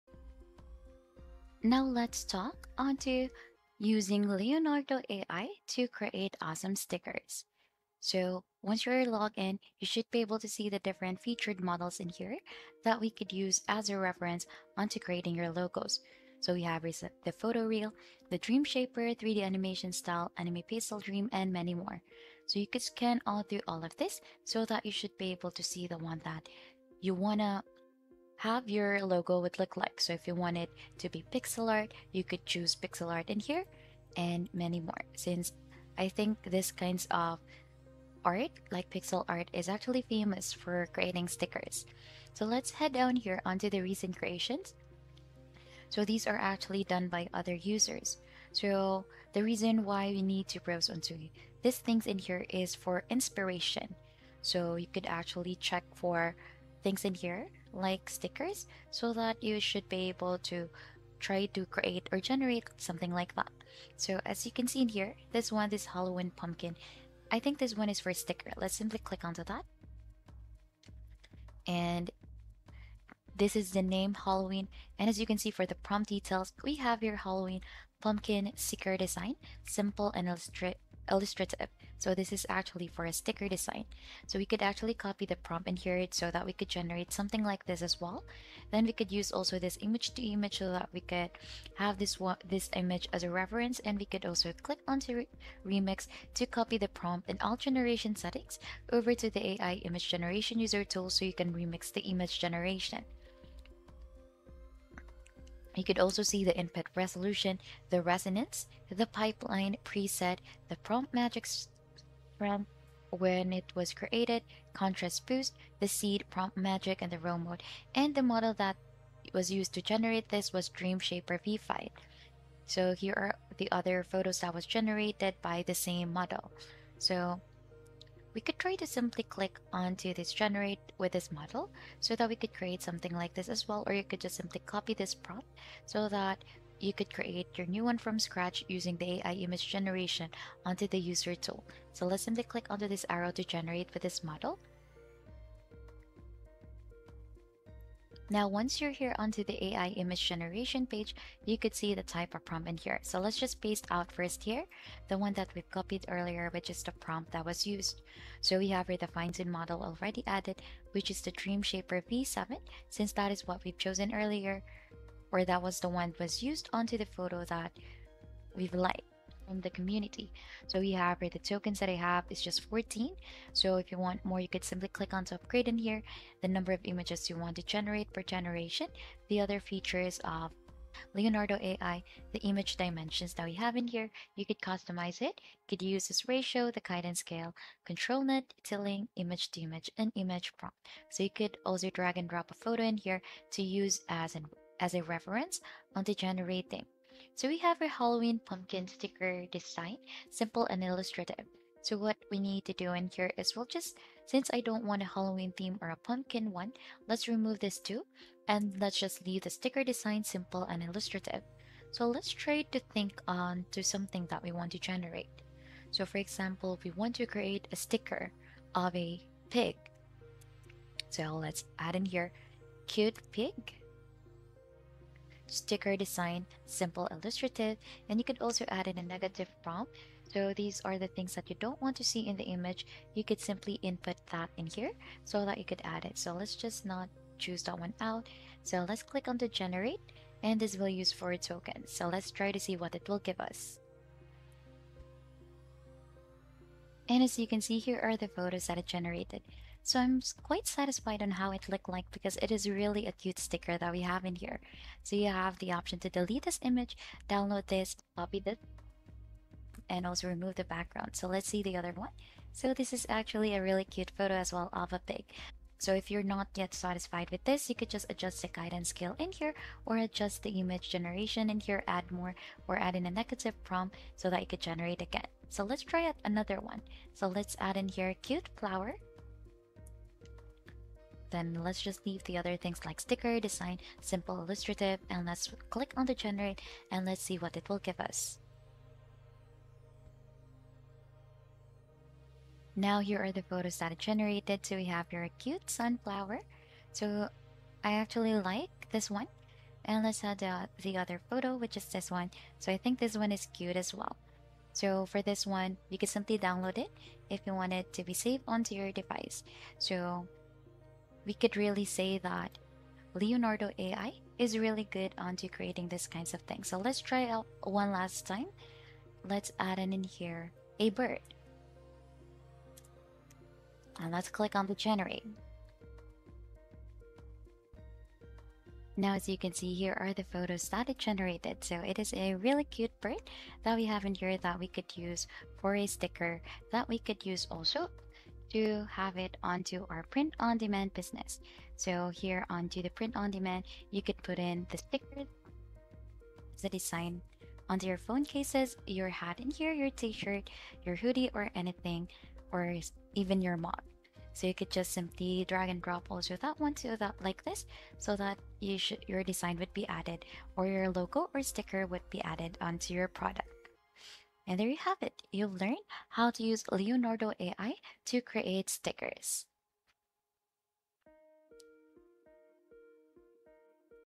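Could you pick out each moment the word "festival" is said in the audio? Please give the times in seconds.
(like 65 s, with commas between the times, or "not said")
not said.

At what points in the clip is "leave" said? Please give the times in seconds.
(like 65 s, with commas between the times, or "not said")
209 s, 282 s.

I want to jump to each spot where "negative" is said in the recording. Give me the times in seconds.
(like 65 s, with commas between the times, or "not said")
229 s, 273 s.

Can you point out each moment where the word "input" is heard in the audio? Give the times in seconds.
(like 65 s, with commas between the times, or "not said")
106 s, 233 s.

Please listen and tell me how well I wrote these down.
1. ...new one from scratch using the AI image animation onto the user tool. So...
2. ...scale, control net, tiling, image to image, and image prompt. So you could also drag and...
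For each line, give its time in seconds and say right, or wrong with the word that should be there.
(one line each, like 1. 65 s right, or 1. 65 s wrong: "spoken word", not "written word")
1. 137 s wrong: "generation", not "animation"
2. 187 s right.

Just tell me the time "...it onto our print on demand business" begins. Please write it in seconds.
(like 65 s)
339 s.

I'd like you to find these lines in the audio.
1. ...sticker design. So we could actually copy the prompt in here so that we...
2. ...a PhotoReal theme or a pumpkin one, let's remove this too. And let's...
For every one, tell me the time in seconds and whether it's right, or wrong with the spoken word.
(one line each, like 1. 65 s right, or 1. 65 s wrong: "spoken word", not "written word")
1. 83 s right
2. 205 s wrong: "Halloween", not "PhotoReal".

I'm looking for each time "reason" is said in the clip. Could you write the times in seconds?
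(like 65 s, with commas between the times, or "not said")
49 s.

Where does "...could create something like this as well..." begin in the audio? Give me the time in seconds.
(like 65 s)
132 s.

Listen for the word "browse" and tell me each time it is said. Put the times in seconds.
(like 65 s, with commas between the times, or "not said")
50 s.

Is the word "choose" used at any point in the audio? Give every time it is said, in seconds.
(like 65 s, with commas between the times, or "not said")
32 s, 237 s.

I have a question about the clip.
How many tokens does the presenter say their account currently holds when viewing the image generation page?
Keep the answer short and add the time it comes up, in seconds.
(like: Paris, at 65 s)
14, at 172 s.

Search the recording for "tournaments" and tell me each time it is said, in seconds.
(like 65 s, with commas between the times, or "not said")
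not said.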